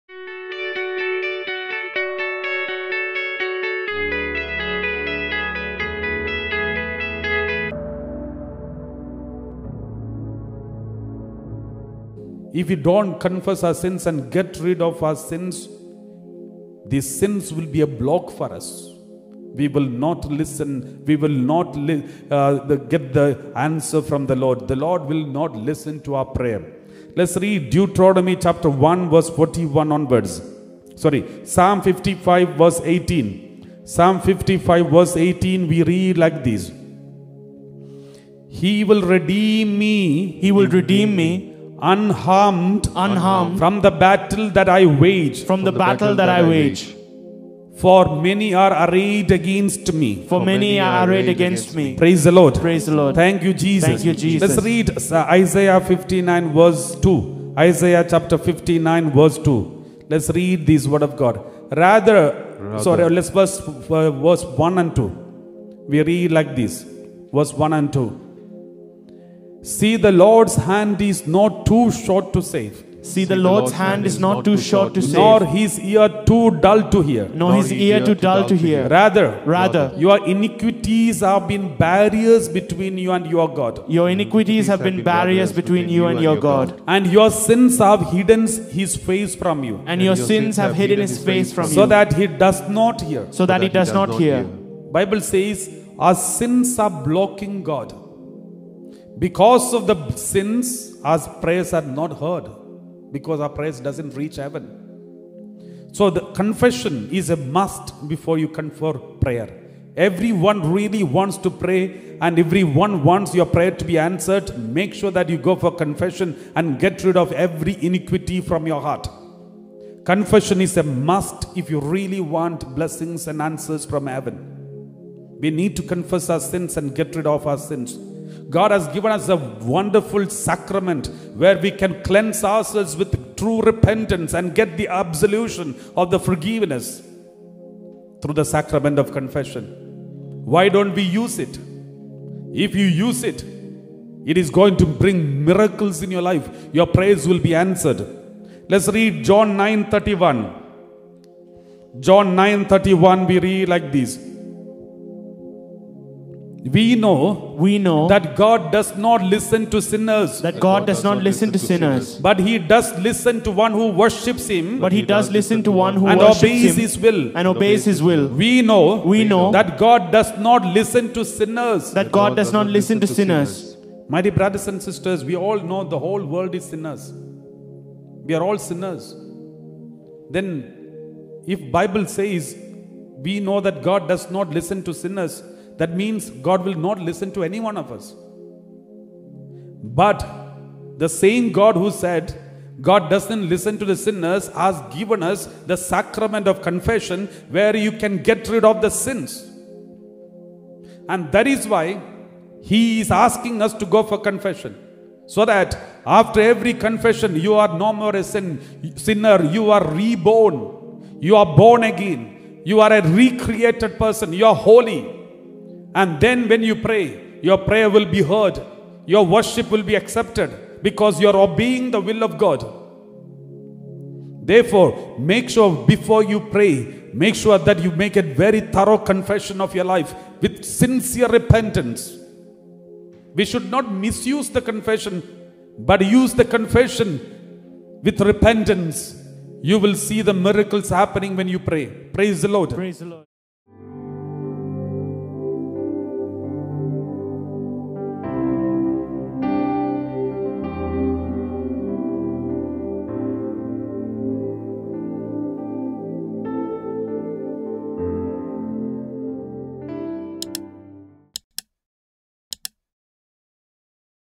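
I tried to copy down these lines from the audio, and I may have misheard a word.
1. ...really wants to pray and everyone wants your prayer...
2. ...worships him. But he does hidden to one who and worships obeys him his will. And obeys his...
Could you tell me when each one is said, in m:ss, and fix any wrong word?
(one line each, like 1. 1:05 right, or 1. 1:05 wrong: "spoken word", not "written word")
1. 1:50 right
2. 2:43 wrong: "listen", not "hidden".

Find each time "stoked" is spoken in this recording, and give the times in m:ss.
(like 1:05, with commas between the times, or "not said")
not said.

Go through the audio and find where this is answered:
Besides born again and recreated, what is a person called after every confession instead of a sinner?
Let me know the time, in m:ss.
3:30.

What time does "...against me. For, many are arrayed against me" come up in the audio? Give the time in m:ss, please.
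0:49.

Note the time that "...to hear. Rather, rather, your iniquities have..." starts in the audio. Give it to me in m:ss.
1:18.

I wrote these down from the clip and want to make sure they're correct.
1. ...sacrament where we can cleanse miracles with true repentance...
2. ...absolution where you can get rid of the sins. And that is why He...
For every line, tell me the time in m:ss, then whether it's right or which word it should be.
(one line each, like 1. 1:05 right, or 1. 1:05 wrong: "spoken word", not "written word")
1. 2:10 wrong: "ourselves", not "miracles"
2. 3:16 wrong: "confession", not "absolution".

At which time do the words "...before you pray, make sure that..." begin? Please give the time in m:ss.
3:45.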